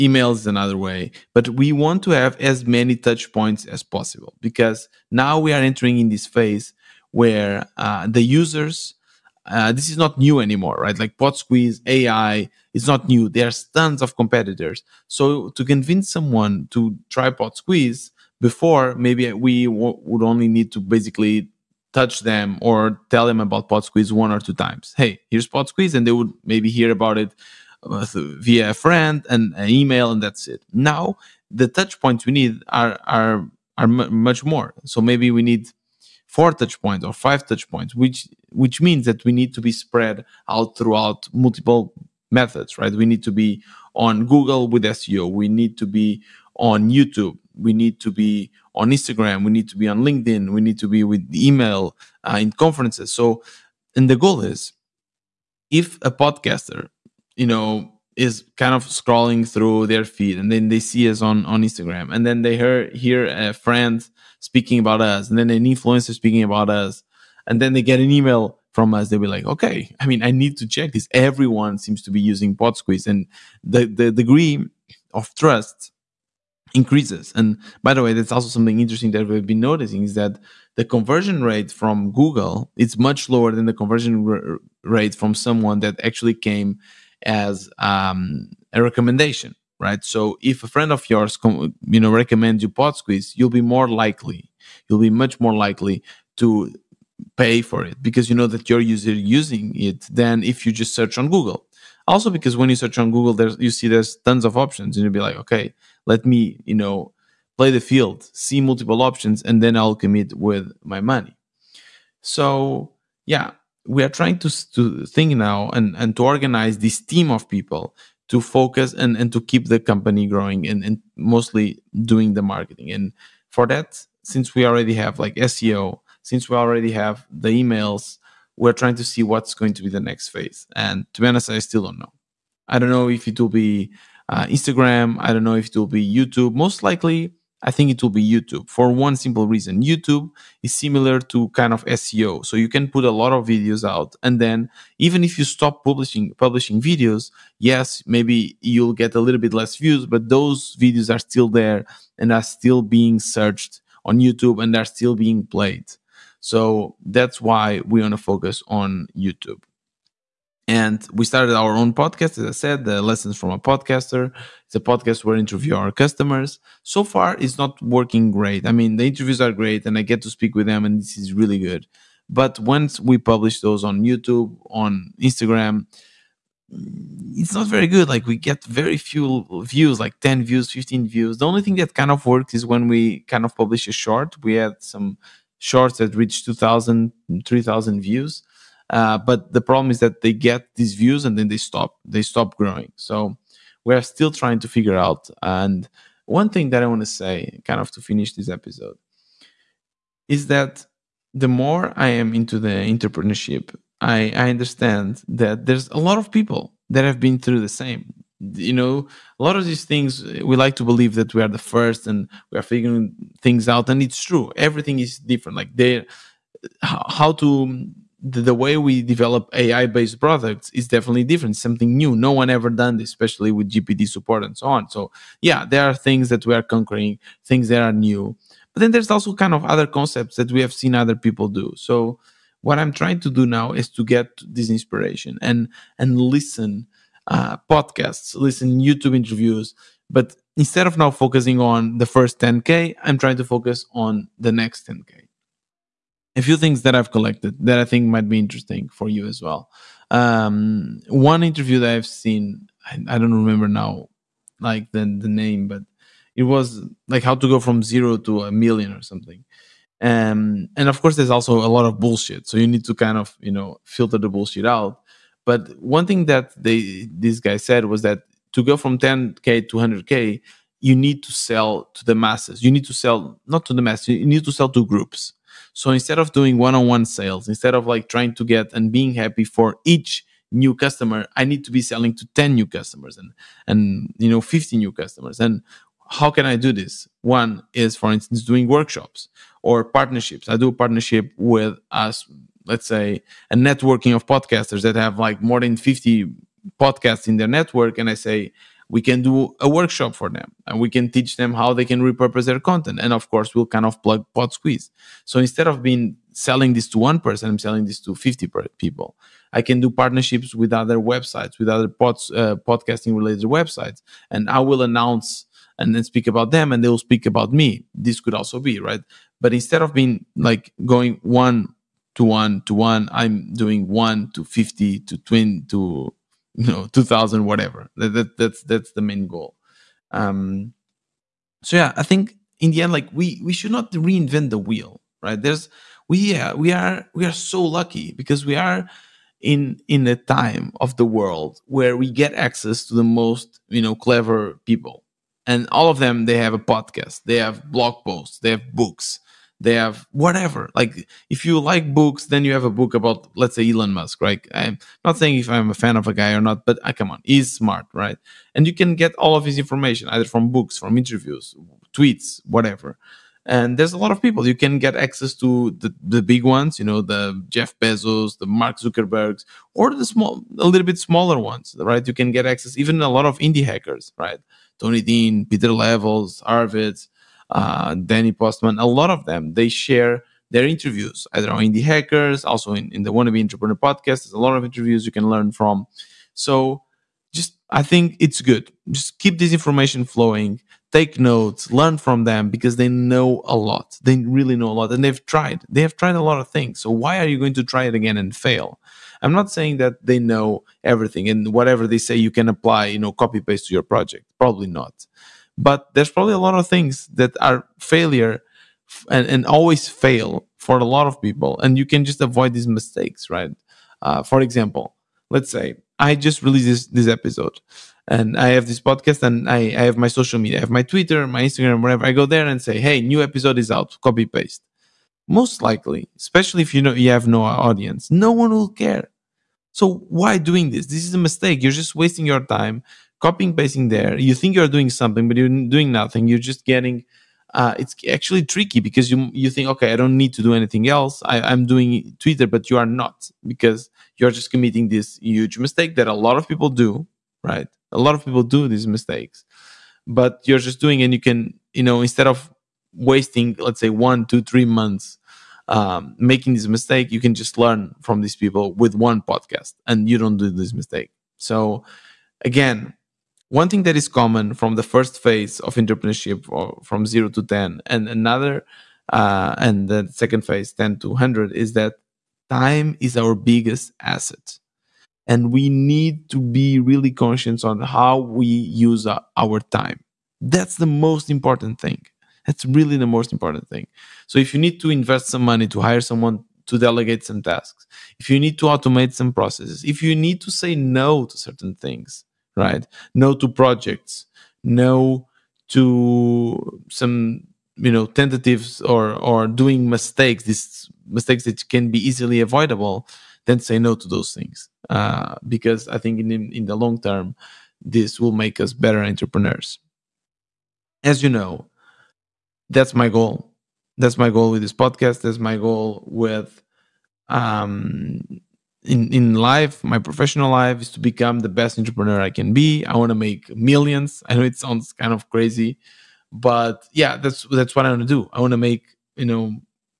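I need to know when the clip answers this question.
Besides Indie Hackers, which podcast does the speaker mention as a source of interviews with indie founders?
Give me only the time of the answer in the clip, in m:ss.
6:23.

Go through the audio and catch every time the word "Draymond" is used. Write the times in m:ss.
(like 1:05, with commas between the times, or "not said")
not said.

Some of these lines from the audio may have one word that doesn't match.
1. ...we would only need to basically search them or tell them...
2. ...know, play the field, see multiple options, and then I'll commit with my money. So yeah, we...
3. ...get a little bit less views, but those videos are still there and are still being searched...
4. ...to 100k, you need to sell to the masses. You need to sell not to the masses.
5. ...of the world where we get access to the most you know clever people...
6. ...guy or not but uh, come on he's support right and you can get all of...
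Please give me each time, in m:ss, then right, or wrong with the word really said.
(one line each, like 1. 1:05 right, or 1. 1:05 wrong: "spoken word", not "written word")
1. 0:19 wrong: "touch", not "search"
2. 1:46 right
3. 2:29 right
4. 4:29 right
5. 5:40 right
6. 5:56 wrong: "smart", not "support".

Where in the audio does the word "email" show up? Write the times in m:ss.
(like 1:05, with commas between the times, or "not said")
0:29, 0:51, 1:08, 2:07.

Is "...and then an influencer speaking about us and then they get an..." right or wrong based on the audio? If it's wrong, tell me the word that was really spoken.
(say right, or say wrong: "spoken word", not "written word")
right.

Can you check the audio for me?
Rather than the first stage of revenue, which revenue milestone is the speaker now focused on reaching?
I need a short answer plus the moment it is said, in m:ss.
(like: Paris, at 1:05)
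the next 10K, at 4:04.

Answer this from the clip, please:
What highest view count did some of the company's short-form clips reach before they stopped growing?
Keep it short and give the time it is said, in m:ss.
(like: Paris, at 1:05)
3,000, at 3:07.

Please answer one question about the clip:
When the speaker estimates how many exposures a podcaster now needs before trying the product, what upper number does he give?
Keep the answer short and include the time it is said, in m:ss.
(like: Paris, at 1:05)
5, at 0:37.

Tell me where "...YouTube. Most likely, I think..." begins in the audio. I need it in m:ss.
2:16.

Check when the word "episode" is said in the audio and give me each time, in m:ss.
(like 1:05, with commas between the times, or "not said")
3:18, 6:57, 7:03.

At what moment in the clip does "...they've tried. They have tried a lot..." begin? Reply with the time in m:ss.
6:35.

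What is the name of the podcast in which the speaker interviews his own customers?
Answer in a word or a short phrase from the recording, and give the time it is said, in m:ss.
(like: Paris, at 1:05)
Lessons from a Podcaster, at 2:43.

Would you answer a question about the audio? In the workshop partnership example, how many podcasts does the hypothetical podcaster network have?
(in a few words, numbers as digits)
more than 50.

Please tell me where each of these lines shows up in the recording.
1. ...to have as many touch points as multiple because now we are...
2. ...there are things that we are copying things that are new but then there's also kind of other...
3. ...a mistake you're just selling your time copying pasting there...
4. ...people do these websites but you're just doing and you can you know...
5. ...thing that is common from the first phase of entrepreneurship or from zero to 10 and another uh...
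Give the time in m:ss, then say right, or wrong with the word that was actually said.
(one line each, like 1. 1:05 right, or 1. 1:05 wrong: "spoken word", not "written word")
1. 0:02 wrong: "possible", not "multiple"
2. 3:45 wrong: "conquering", not "copying"
3. 7:11 wrong: "wasting", not "selling"
4. 7:28 wrong: "mistakes", not "websites"
5. 7:43 right.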